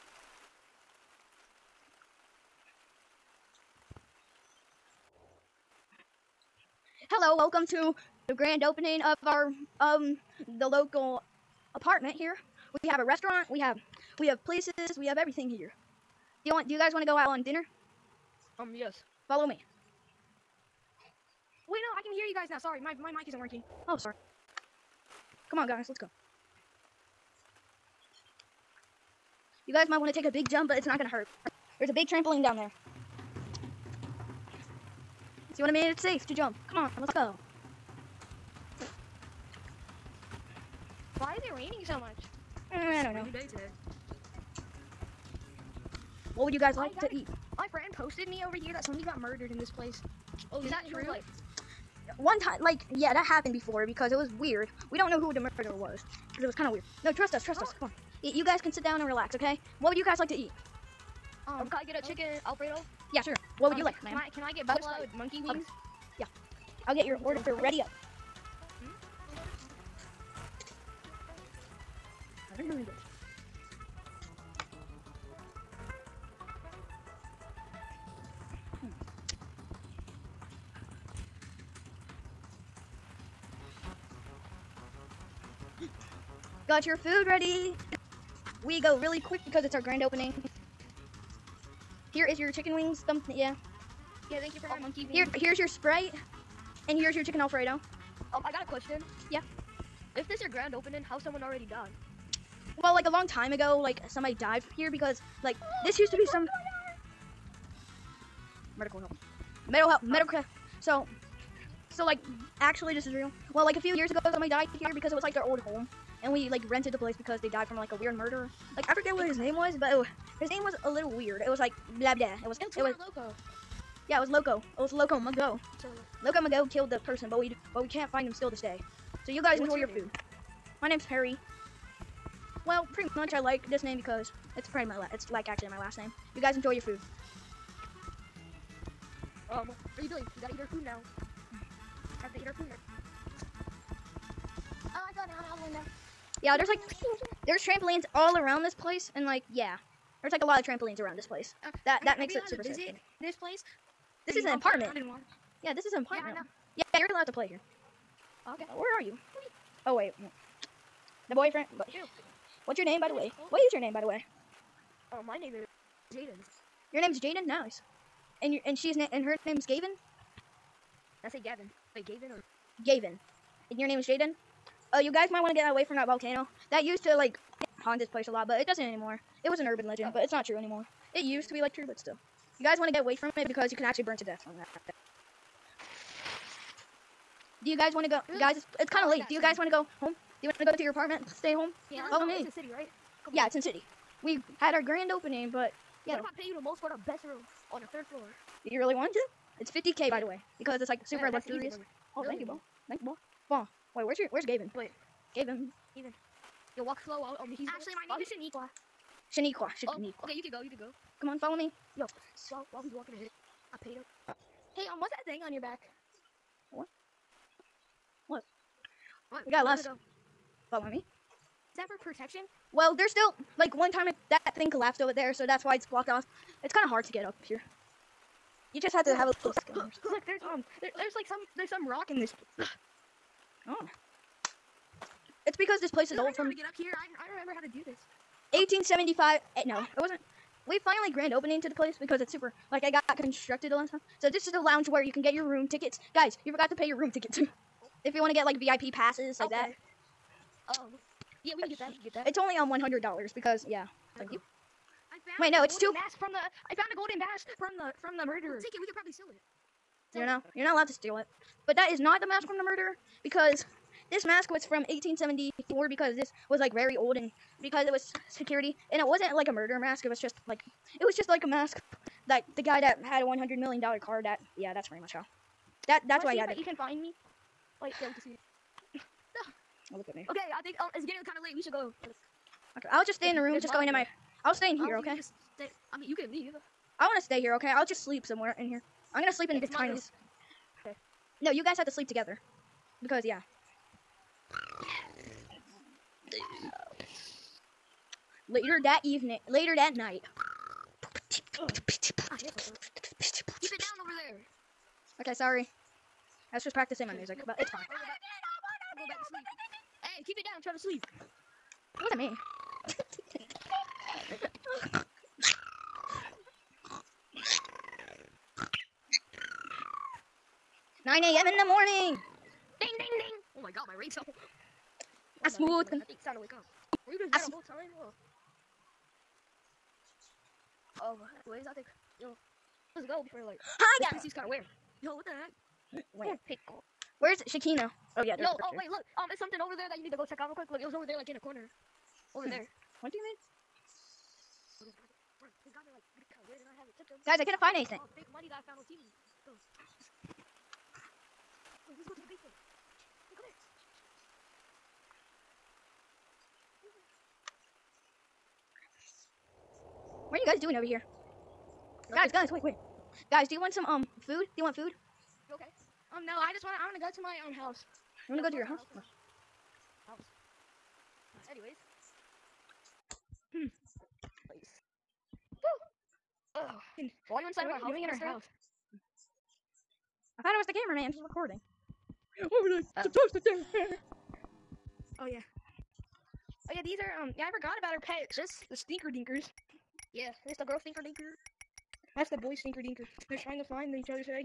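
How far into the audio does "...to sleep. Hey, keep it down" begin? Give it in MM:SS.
05:09.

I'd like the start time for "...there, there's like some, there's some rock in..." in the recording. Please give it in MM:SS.
03:50.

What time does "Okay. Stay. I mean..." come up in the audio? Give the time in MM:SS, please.
04:44.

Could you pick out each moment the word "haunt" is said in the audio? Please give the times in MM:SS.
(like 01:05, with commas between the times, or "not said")
02:57.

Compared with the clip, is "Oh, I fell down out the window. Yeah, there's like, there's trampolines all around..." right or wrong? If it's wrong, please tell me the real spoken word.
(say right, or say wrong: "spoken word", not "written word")
right.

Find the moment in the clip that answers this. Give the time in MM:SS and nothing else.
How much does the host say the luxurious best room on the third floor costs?
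03:19.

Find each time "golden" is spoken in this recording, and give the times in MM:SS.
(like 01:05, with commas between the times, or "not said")
04:16.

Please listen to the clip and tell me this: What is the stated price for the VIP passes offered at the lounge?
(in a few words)
100 dollars.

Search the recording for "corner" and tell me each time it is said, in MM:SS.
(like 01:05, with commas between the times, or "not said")
05:41.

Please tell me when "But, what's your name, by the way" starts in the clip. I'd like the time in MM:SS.
02:41.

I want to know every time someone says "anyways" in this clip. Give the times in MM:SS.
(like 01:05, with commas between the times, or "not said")
05:31, 06:11.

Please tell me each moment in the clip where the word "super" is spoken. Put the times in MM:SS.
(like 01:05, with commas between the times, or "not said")
02:32, 03:21, 04:02.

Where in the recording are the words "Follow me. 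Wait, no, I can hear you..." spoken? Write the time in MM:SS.
00:19.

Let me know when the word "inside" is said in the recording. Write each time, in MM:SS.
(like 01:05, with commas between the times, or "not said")
06:17.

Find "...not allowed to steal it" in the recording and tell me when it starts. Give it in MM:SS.
04:20.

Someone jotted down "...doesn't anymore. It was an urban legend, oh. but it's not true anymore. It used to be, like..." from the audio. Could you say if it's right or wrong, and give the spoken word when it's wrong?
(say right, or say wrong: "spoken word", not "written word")
right.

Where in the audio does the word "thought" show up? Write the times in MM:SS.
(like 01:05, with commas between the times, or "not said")
06:20.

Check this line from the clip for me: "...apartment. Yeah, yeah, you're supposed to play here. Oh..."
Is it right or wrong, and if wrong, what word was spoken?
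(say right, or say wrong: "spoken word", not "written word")
wrong: "allowed", not "supposed".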